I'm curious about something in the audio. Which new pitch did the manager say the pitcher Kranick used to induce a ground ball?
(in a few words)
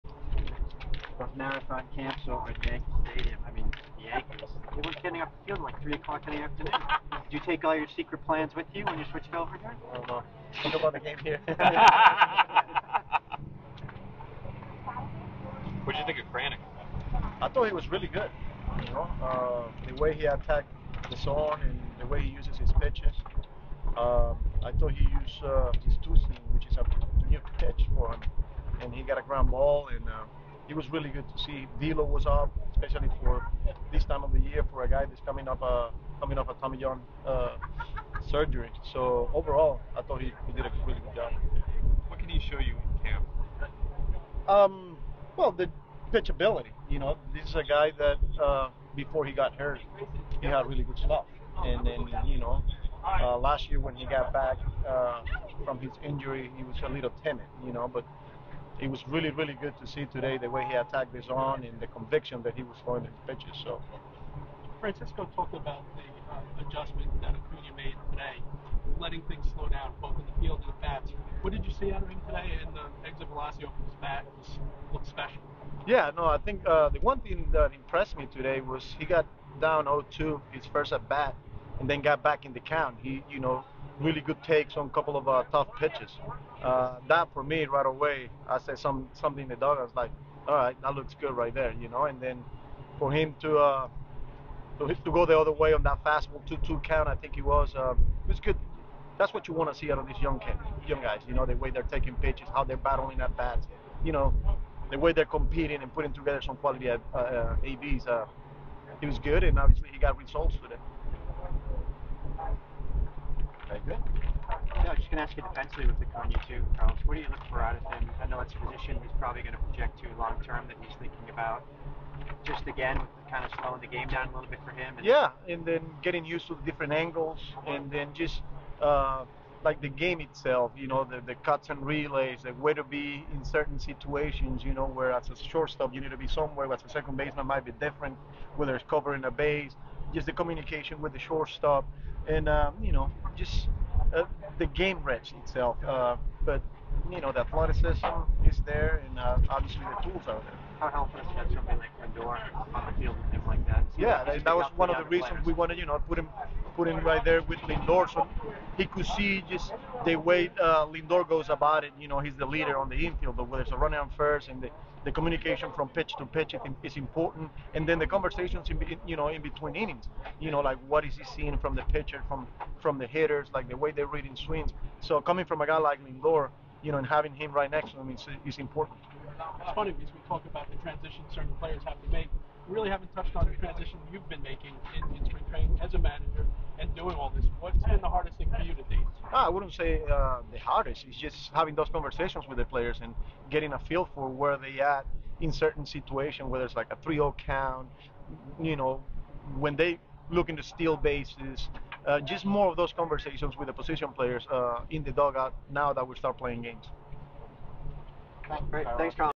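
Two seam.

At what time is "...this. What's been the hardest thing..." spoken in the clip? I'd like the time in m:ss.
3:07.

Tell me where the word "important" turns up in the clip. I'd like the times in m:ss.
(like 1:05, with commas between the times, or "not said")
2:46, 2:58.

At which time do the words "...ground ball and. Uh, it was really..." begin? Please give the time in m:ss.
0:29.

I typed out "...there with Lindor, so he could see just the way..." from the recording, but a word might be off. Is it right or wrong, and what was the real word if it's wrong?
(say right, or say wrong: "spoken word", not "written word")
right.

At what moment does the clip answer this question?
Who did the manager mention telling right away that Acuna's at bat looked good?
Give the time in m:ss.
1:29.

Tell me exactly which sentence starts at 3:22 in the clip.
Uh, just more of those conversations with the position players uh, in the dugout now that we start playing games.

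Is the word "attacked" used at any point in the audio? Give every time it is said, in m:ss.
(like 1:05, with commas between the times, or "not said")
0:20, 1:00.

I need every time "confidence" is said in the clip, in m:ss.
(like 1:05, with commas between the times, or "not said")
not said.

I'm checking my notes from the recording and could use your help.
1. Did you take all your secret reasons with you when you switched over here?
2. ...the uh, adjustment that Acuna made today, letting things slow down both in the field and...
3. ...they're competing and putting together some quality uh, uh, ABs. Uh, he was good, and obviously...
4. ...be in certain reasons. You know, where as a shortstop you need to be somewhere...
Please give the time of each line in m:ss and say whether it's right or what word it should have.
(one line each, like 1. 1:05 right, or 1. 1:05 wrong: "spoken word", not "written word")
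1. 0:07 wrong: "plans", not "reasons"
2. 1:05 right
3. 1:45 right
4. 2:12 wrong: "situations", not "reasons".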